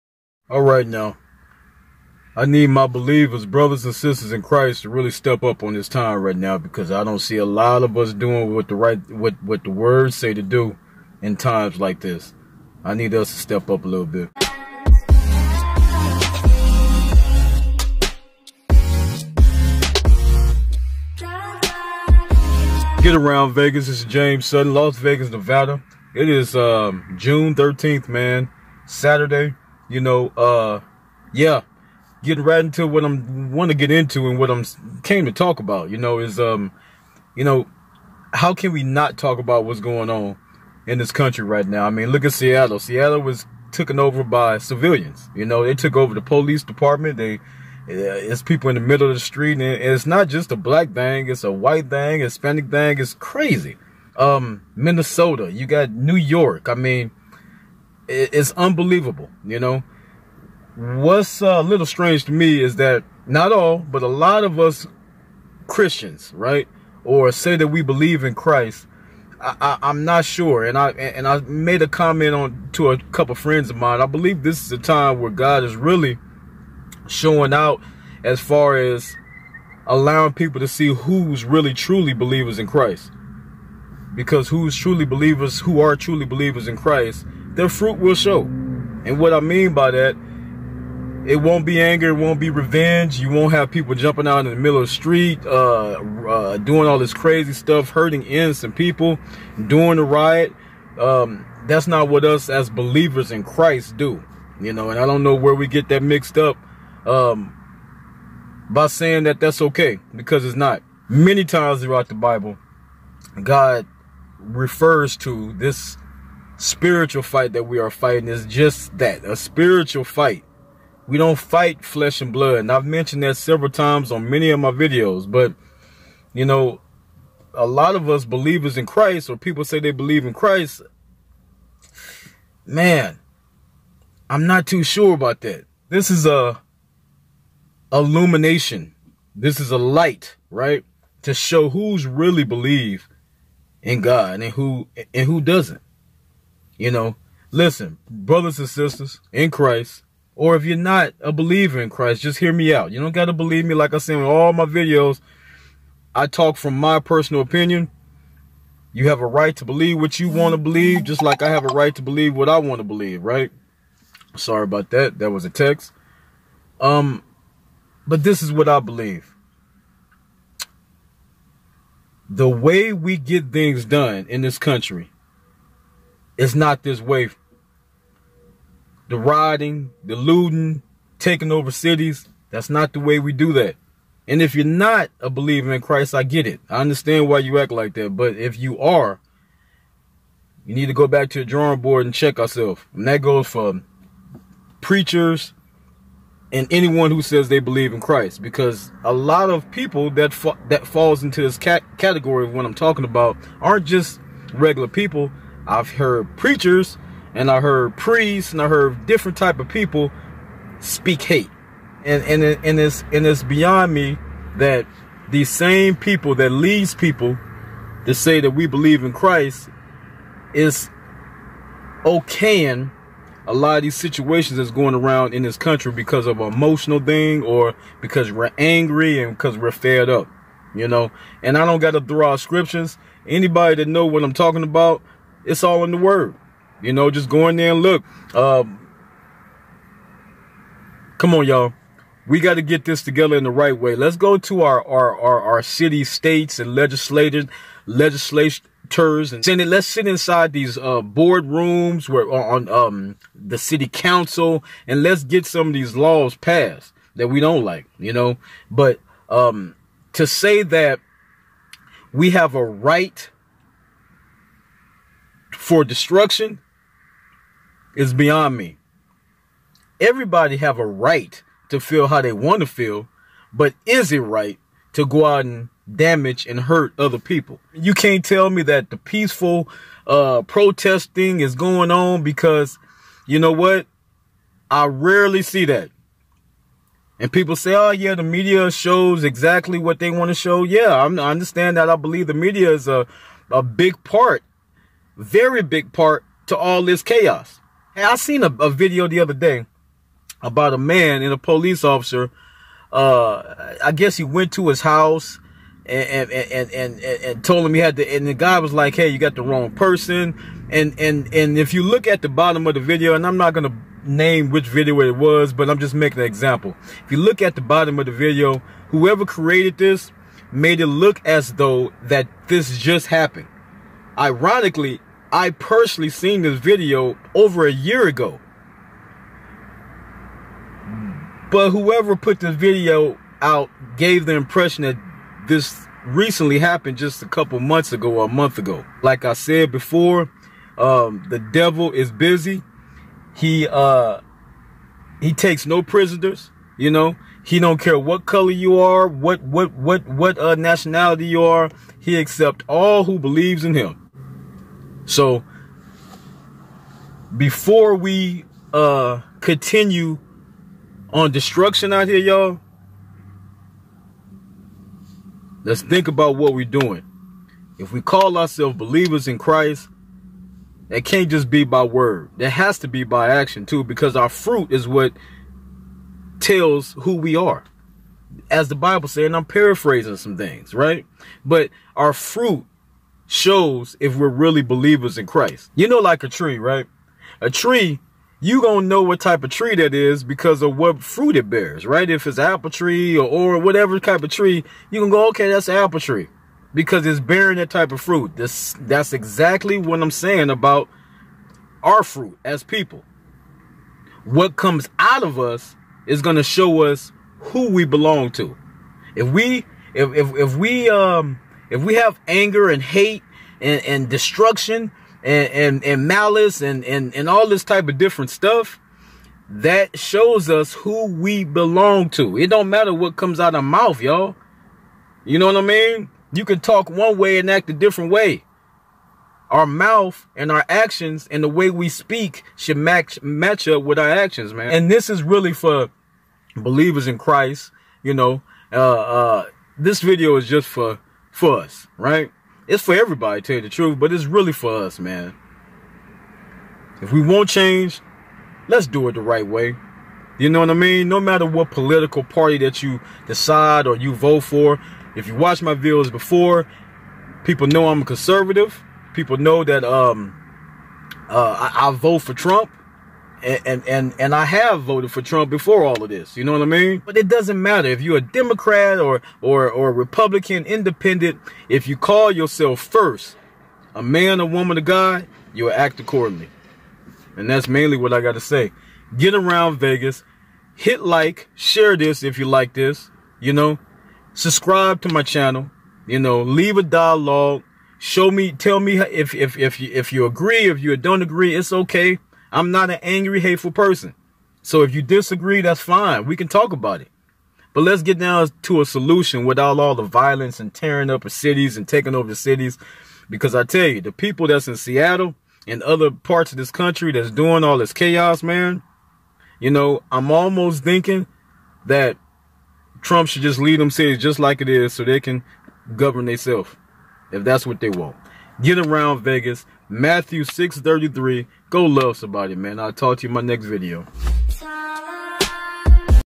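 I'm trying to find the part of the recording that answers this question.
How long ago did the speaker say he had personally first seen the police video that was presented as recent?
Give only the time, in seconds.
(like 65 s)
327 s.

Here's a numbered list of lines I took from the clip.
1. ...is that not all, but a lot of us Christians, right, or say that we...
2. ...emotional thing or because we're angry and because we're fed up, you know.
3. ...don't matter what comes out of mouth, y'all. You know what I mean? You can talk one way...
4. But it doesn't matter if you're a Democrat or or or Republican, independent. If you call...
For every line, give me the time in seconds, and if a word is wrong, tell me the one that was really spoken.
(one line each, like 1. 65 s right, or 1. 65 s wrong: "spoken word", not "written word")
1. 62 s right
2. 226 s right
3. 422 s right
4. 467 s right.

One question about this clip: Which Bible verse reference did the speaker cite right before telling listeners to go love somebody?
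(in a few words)
Matthew 6:33.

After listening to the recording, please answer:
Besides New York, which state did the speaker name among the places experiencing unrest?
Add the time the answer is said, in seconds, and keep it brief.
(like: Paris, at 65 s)
Minnesota, at 54 s.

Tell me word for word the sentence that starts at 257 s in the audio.
You know, but um, to say that we have a right for destruction is beyond me.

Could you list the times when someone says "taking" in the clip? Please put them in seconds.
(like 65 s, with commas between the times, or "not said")
181 s, 501 s.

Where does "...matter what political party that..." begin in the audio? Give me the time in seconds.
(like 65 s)
451 s.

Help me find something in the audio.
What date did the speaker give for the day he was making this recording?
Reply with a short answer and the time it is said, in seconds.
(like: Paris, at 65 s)
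June 13th, at 27 s.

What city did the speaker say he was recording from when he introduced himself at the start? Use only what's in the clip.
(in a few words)
Las Vegas, Nevada.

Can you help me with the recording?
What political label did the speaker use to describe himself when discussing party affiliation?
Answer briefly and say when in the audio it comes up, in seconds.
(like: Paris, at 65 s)
conservative, at 458 s.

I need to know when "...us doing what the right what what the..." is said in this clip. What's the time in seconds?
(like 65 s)
7 s.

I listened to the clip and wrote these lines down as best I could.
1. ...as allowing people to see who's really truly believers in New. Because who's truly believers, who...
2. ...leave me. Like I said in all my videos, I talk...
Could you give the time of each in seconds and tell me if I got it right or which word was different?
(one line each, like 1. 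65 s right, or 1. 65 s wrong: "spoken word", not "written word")
1. 78 s wrong: "Christ", not "New"
2. 153 s wrong: "believe", not "leave".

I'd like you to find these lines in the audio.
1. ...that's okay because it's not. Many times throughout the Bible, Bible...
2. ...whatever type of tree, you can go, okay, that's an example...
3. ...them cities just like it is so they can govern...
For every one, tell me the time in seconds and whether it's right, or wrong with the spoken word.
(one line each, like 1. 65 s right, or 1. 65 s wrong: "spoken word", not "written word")
1. 109 s wrong: "God", not "Bible"
2. 393 s wrong: "apple", not "example"
3. 513 s right.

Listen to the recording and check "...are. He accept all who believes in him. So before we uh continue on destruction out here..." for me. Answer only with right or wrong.
right.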